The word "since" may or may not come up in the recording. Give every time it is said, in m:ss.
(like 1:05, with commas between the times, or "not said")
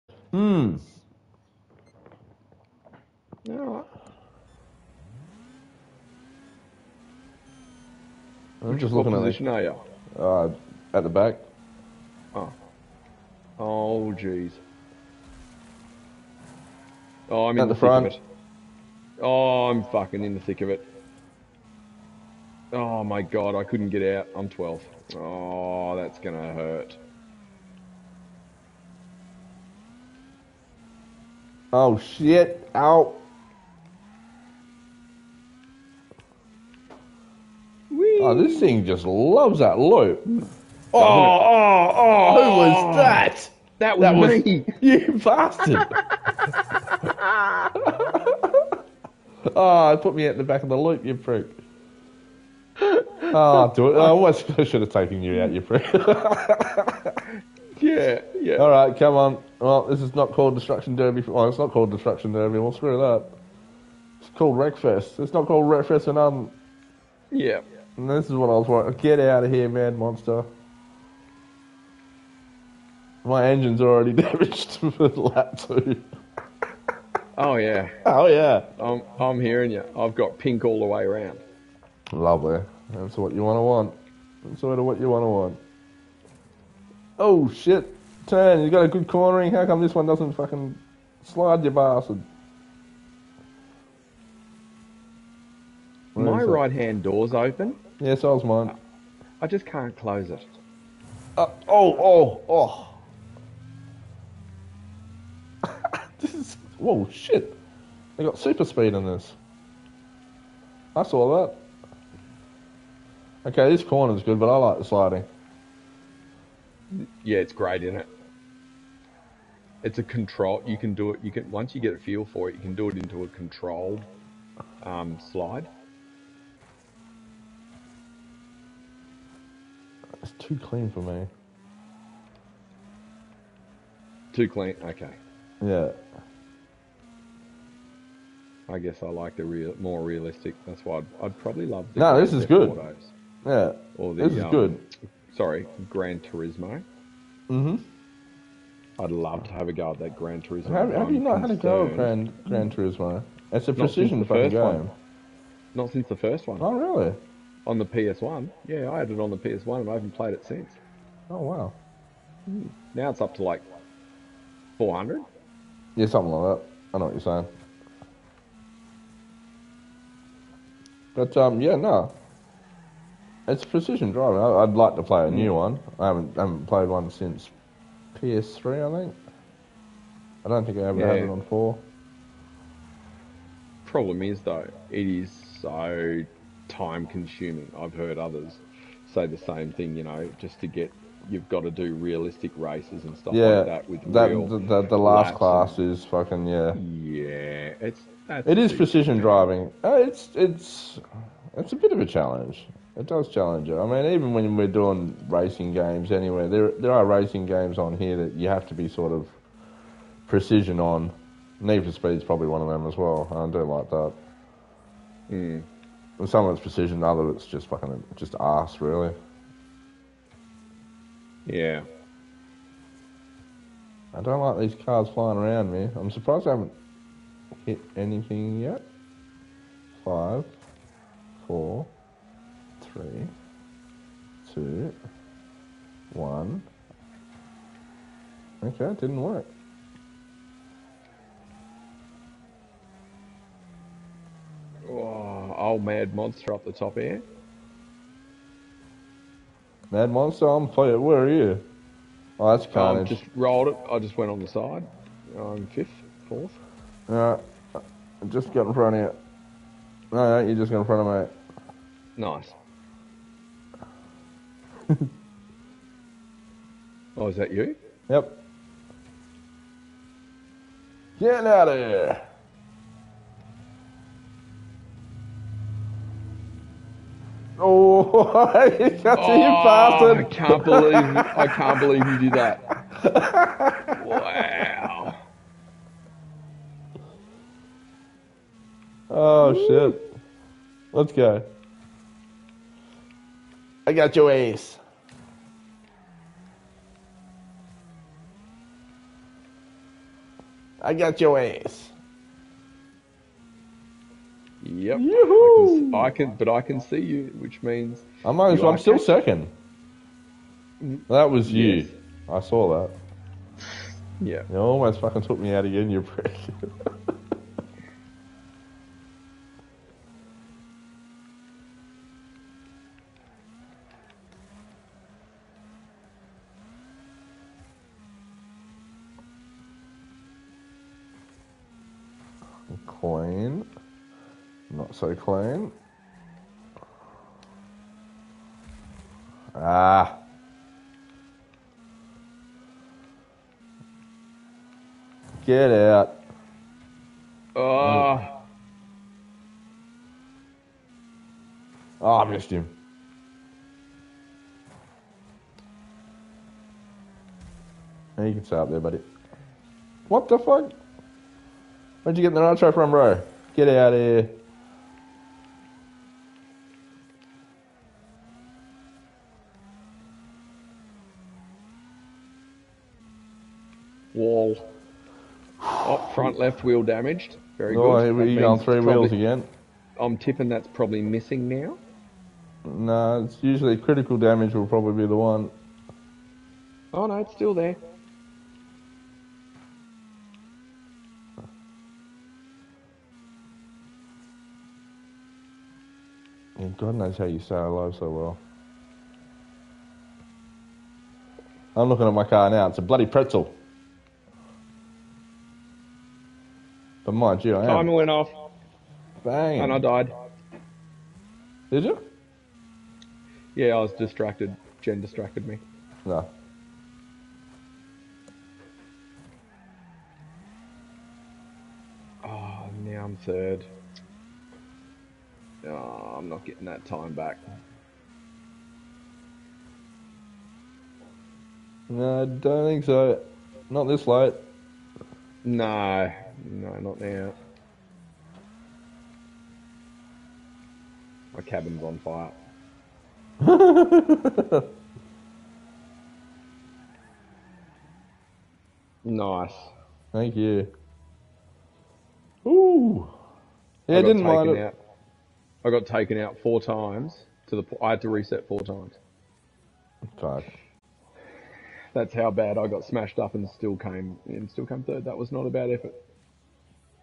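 2:35, 2:40, 2:57.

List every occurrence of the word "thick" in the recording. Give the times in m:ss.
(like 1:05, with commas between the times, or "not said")
0:20.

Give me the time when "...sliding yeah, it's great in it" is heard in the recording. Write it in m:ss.
1:54.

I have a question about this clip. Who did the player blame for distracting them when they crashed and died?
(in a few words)
Jen.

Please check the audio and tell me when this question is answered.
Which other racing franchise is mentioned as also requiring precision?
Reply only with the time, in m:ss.
3:31.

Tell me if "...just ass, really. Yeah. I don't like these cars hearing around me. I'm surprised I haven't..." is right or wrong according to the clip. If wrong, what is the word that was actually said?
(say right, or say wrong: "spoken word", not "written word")
wrong: "flying", not "hearing".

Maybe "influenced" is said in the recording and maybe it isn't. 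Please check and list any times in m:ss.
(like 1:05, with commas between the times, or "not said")
not said.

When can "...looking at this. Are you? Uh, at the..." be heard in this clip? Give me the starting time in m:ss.
0:08.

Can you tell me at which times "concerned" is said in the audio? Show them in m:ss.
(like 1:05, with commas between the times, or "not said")
2:31.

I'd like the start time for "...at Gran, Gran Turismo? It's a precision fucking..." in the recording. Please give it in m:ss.
2:31.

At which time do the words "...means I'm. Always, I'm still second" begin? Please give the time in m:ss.
5:07.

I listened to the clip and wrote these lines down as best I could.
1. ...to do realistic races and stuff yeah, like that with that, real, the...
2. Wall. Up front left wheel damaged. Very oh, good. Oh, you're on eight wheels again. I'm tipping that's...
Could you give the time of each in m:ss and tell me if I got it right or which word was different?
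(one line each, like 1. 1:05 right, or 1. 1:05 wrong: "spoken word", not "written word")
1. 3:11 right
2. 6:14 wrong: "three", not "eight".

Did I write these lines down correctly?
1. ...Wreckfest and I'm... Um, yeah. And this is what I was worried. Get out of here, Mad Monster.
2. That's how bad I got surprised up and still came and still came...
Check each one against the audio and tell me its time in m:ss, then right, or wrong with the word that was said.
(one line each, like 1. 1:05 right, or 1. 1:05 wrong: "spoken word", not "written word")
1. 1:05 right
2. 7:41 wrong: "smashed", not "surprised".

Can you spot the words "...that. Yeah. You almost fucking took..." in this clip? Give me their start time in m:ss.
5:12.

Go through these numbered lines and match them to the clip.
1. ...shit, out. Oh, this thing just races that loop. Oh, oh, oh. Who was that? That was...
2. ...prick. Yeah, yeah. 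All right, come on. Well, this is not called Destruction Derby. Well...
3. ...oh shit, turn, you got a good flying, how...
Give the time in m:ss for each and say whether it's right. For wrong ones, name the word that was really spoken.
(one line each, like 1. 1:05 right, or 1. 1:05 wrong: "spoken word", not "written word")
1. 0:31 wrong: "loves", not "races"
2. 0:55 right
3. 1:27 wrong: "cornering", not "flying".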